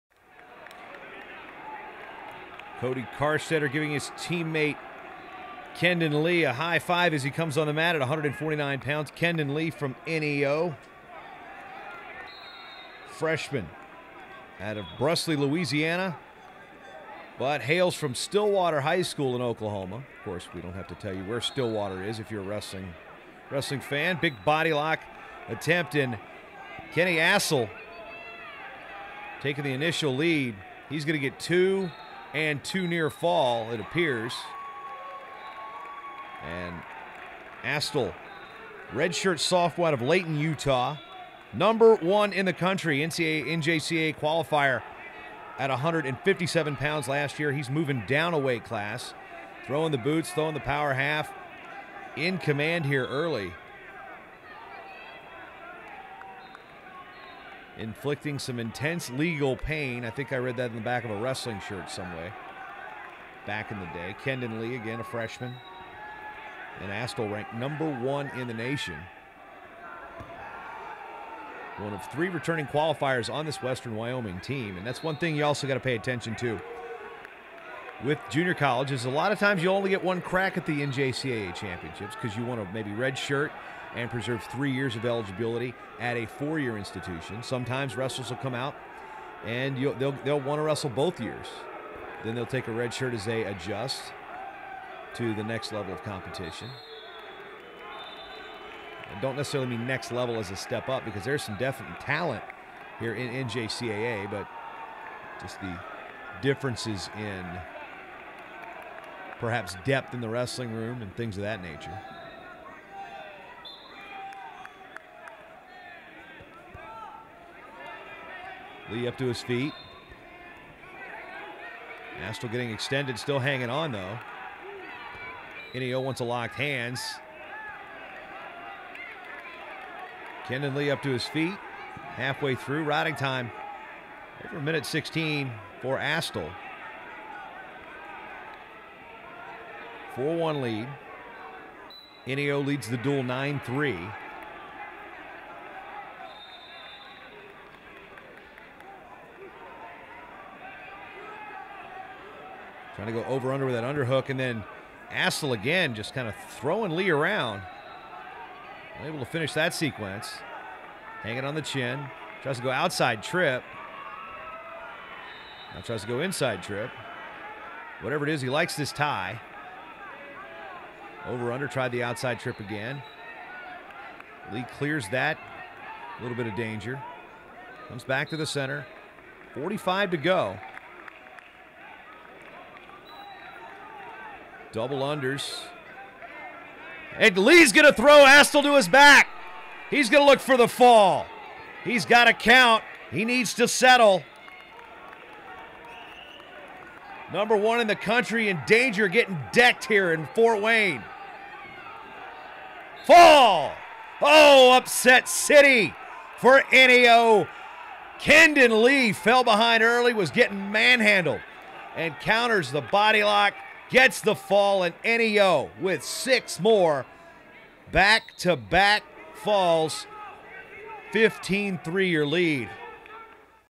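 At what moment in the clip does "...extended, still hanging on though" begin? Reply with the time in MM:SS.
02:02.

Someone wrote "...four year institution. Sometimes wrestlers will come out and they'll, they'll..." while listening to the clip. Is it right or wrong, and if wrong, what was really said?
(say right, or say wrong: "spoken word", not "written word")
right.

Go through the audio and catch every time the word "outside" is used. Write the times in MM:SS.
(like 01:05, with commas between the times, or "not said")
02:42, 02:52.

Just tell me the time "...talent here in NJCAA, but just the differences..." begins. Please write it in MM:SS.
01:41.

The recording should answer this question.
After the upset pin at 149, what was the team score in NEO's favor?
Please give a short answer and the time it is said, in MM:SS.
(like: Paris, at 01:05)
15-3, at 03:41.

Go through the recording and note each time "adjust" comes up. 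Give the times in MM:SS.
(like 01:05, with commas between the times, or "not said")
01:33.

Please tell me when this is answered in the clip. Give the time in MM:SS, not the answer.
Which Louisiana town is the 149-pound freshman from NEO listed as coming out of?
00:14.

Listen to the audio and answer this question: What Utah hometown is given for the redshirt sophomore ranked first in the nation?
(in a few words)
Layton, Utah.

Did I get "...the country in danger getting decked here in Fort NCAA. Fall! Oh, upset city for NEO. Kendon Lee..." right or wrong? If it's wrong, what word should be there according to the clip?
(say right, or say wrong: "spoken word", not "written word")
wrong: "Wayne", not "NCAA".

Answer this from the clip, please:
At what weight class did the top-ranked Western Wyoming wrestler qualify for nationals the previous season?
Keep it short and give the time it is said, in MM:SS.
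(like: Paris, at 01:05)
157 pounds, at 00:45.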